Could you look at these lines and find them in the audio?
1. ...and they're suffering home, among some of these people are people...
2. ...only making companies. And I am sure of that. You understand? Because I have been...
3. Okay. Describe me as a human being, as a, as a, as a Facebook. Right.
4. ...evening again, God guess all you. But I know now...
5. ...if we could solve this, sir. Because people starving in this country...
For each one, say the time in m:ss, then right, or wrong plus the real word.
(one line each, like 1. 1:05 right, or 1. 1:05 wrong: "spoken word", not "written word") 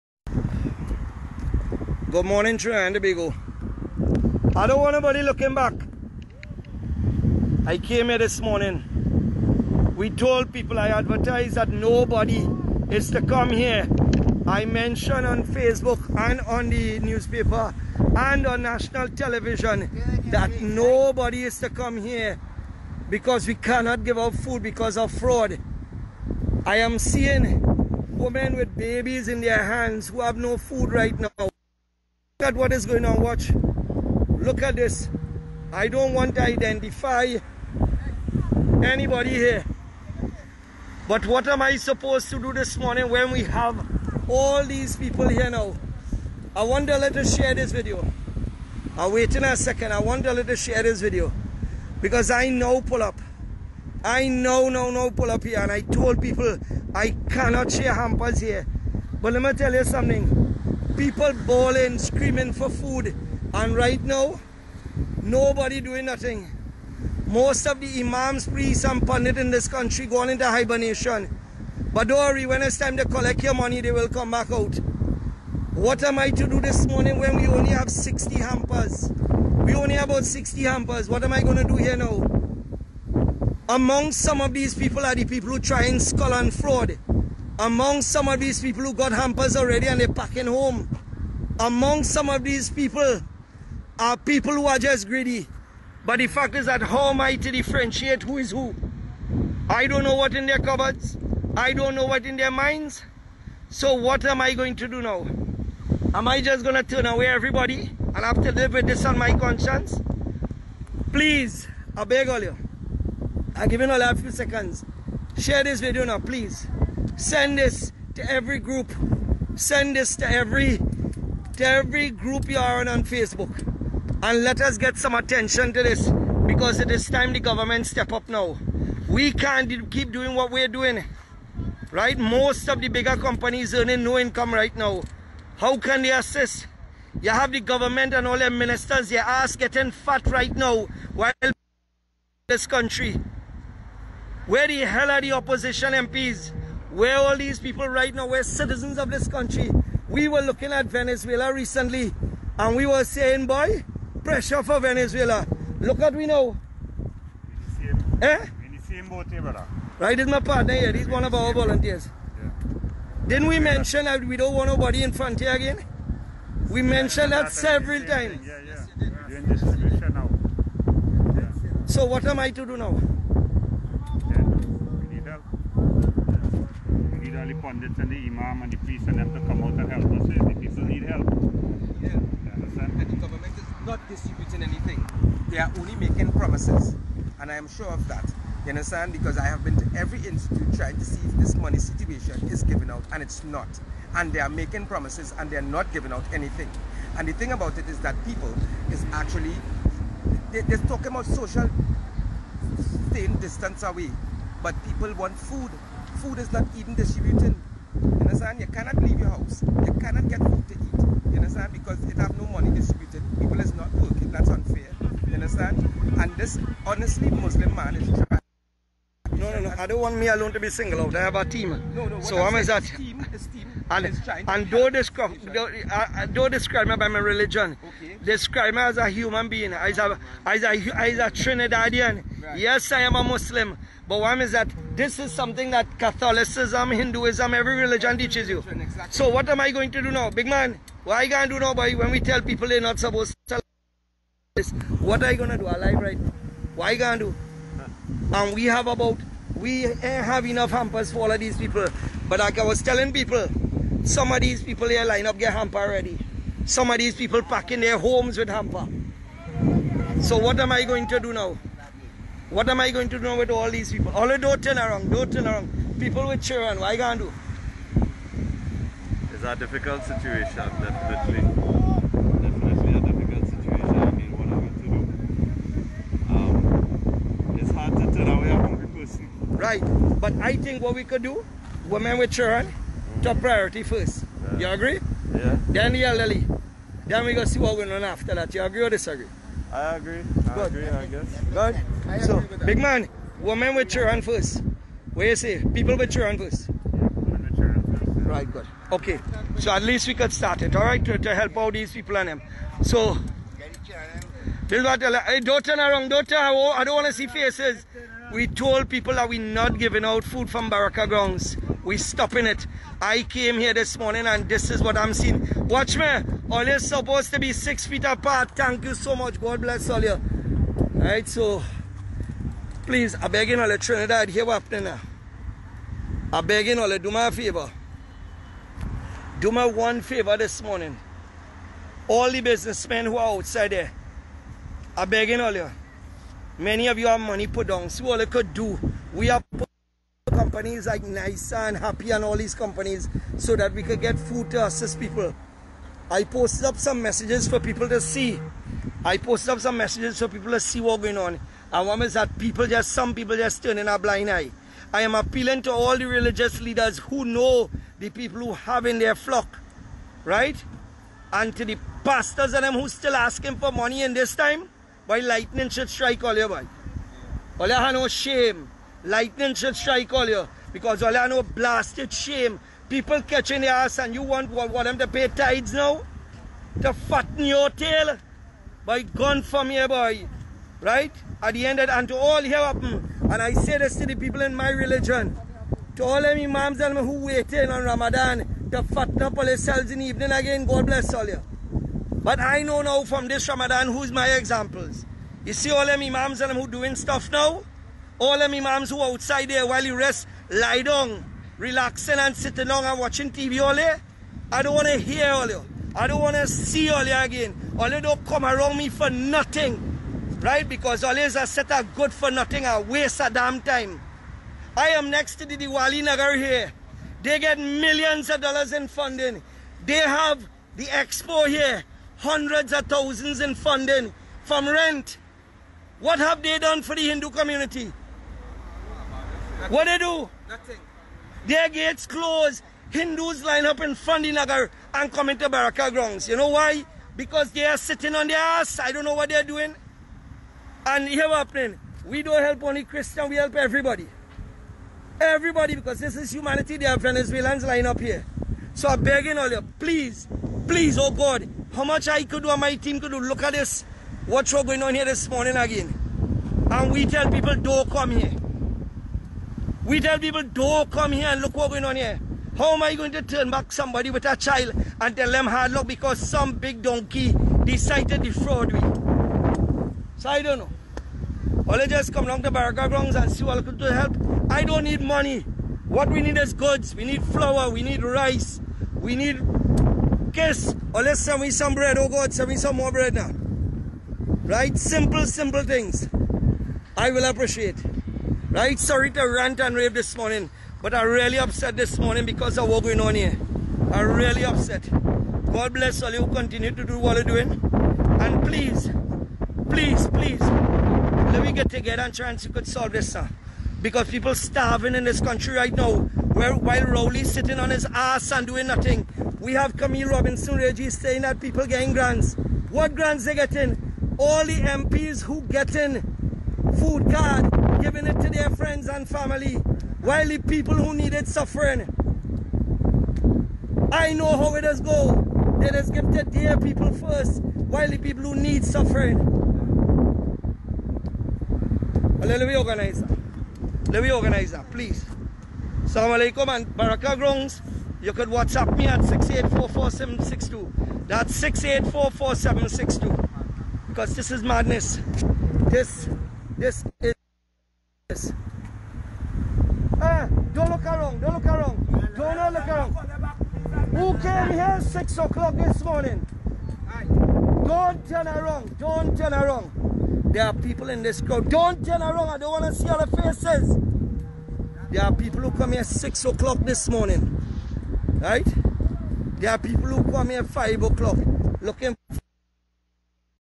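1. 1:29 wrong: "packing", not "suffering"
2. 3:05 wrong: "promises", not "companies"
3. 3:48 wrong: "Trinidadian", not "Facebook"
4. 6:30 wrong: "bless", not "guess"
5. 8:22 right.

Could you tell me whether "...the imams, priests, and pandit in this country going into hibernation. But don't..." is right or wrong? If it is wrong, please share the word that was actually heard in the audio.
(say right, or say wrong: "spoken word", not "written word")
right.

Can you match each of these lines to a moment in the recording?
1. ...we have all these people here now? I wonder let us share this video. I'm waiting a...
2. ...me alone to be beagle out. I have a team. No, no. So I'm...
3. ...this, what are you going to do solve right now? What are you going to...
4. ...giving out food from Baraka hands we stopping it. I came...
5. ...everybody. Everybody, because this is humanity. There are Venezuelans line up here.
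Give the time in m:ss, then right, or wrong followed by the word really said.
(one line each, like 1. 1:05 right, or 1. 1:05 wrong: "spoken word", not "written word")
1. 0:43 right
2. 3:40 wrong: "single", not "beagle"
3. 4:04 wrong: "alive", not "solve"
4. 5:09 wrong: "grounds", not "hands"
5. 7:23 right.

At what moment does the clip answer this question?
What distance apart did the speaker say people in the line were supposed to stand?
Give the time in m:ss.
5:17.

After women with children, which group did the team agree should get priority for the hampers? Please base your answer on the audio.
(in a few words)
The elderly.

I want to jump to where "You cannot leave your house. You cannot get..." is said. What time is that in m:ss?
3:28.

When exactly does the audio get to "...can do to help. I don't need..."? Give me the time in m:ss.
7:53.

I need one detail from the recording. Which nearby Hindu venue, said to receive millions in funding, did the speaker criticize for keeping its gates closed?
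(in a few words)
Diwali Nagar.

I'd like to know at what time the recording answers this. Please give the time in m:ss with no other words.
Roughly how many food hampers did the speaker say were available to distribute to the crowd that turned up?
1:19.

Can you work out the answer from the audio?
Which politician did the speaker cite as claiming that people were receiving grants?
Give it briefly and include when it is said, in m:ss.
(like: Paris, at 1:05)
Camille Robinson Regis, at 8:29.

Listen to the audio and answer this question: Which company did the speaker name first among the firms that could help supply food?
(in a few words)
NISA.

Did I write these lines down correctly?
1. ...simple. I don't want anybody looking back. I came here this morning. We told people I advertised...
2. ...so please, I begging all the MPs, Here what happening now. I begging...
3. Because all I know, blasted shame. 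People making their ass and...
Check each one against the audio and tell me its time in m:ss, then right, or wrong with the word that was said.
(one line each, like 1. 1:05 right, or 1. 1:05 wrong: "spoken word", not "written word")
1. 0:03 wrong: "beagle", not "simple"
2. 5:21 wrong: "Trinidad", not "MPs"
3. 6:10 wrong: "catching", not "making".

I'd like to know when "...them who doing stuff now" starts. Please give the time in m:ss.
6:36.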